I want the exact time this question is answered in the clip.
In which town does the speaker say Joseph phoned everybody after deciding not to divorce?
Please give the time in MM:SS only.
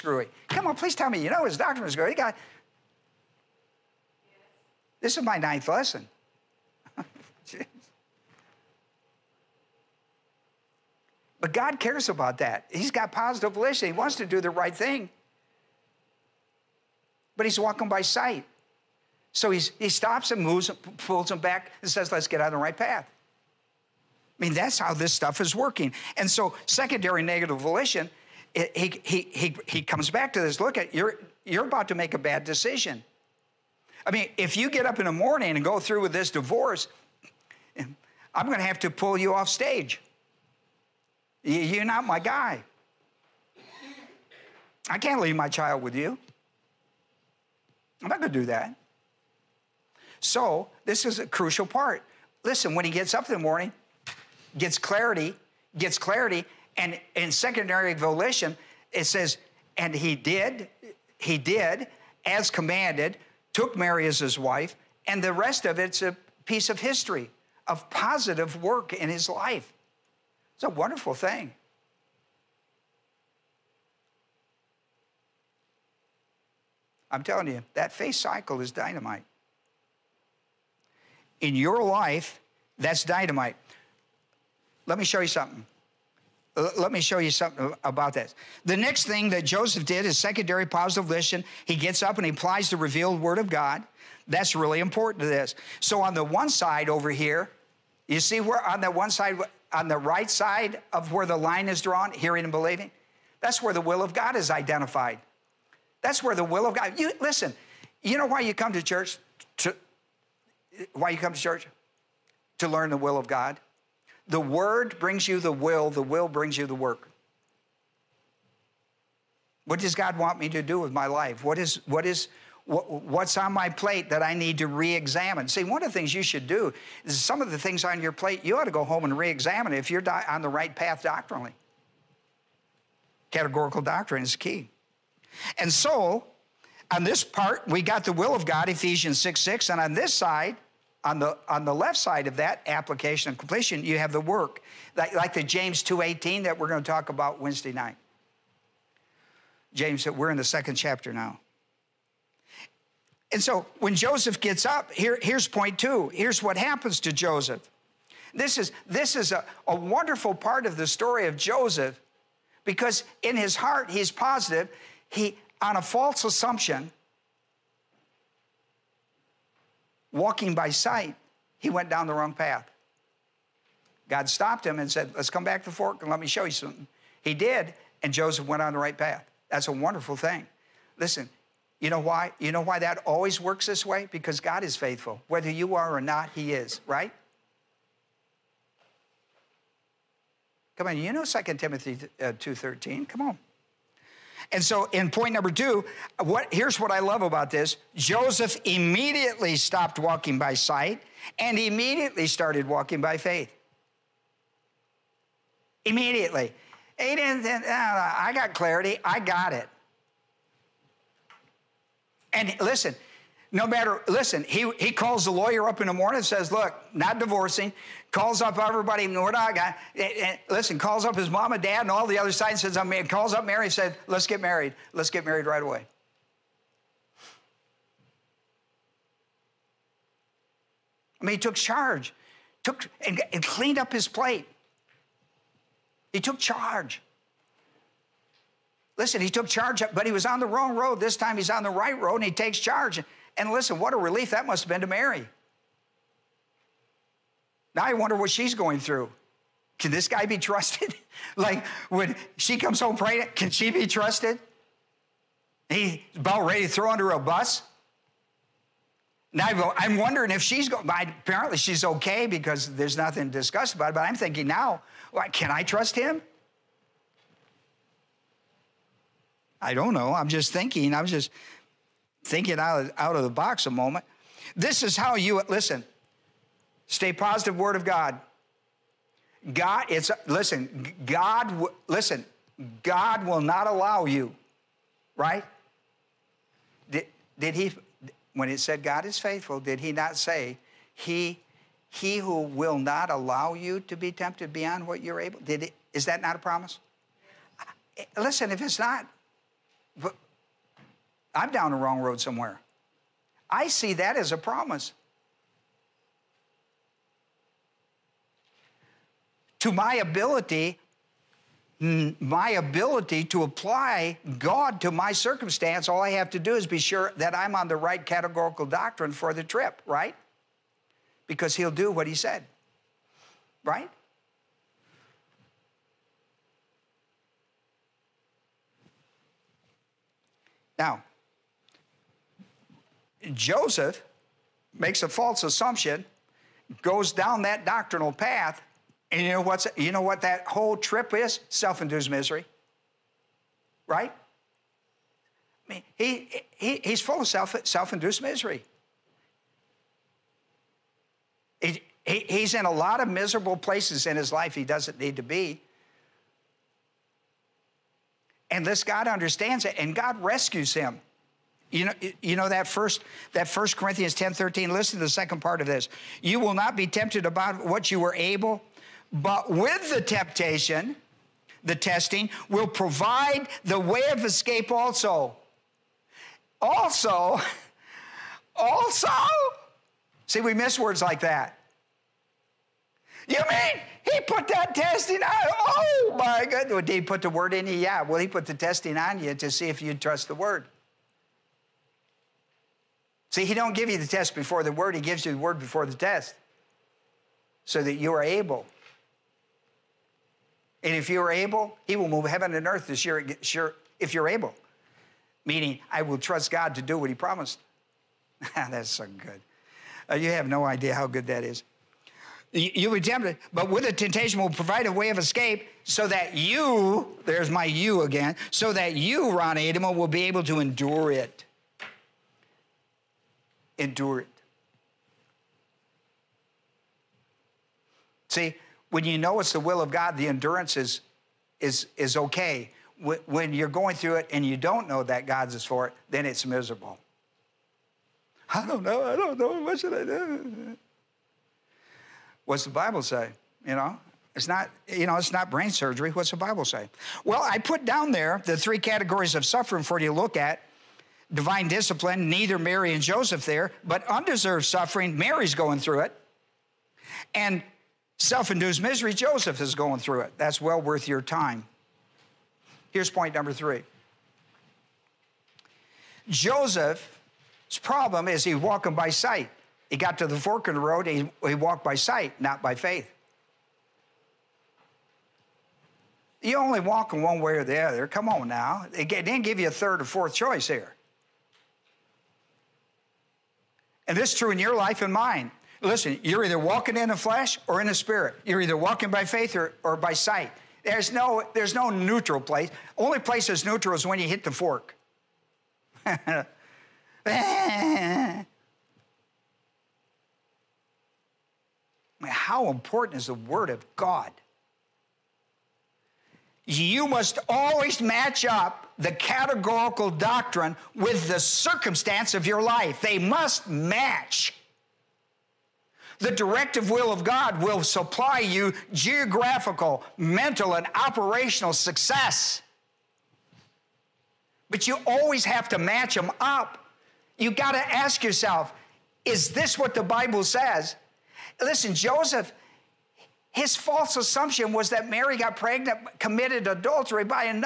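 03:39.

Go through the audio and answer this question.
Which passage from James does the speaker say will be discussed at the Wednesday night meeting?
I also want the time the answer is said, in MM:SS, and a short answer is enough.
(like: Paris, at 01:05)
James 2:18, at 02:25.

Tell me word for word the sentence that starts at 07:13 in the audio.
When you're going through it and you don't know that God's is for it, then it's miserable.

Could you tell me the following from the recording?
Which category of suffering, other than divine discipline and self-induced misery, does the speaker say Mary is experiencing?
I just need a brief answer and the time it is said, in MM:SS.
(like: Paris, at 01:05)
Undeserved suffering, at 07:34.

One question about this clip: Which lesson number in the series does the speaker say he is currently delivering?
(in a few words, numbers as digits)
9th.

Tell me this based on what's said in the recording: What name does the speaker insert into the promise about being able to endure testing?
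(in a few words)
Ron Adema.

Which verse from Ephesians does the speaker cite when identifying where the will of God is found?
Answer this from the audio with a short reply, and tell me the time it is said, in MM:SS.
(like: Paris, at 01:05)
Ephesians 6:6, at 02:18.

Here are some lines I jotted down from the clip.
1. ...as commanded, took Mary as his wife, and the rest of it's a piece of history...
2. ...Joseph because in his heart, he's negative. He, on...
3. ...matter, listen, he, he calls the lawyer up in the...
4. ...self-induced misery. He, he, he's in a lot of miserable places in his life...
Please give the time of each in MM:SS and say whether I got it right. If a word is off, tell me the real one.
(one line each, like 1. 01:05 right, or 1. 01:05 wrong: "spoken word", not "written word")
1. 01:02 right
2. 02:41 wrong: "positive", not "negative"
3. 03:33 right
4. 05:47 right.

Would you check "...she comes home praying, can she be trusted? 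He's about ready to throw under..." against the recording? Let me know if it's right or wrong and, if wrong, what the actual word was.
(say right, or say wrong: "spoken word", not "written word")
right.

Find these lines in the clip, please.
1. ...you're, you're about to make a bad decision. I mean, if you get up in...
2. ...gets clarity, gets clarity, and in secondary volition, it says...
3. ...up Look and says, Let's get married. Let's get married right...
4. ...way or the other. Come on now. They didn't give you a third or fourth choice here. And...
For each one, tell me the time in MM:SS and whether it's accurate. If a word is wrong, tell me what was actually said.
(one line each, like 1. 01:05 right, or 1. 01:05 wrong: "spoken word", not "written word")
1. 00:30 right
2. 00:54 right
3. 03:43 wrong: "Mary", not "Look"
4. 07:57 right.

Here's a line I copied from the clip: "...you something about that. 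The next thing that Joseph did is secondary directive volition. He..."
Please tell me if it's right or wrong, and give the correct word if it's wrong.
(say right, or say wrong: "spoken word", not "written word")
wrong: "positive", not "directive".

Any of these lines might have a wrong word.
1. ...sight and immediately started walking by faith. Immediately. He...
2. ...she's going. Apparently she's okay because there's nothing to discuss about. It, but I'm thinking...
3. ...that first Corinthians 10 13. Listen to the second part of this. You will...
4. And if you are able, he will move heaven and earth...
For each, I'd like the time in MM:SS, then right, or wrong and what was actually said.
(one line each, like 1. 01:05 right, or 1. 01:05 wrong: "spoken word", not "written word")
1. 03:20 right
2. 04:20 right
3. 06:03 right
4. 06:40 right.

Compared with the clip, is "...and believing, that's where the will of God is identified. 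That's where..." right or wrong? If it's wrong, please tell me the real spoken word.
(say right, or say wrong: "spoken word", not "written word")
right.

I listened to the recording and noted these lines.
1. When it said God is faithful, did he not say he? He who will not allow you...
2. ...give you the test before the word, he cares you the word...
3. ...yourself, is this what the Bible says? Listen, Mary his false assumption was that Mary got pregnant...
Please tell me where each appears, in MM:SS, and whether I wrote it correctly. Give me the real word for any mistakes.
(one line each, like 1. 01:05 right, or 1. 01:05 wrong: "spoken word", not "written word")
1. 04:48 right
2. 06:33 wrong: "gives", not "cares"
3. 08:48 wrong: "Joseph", not "Mary".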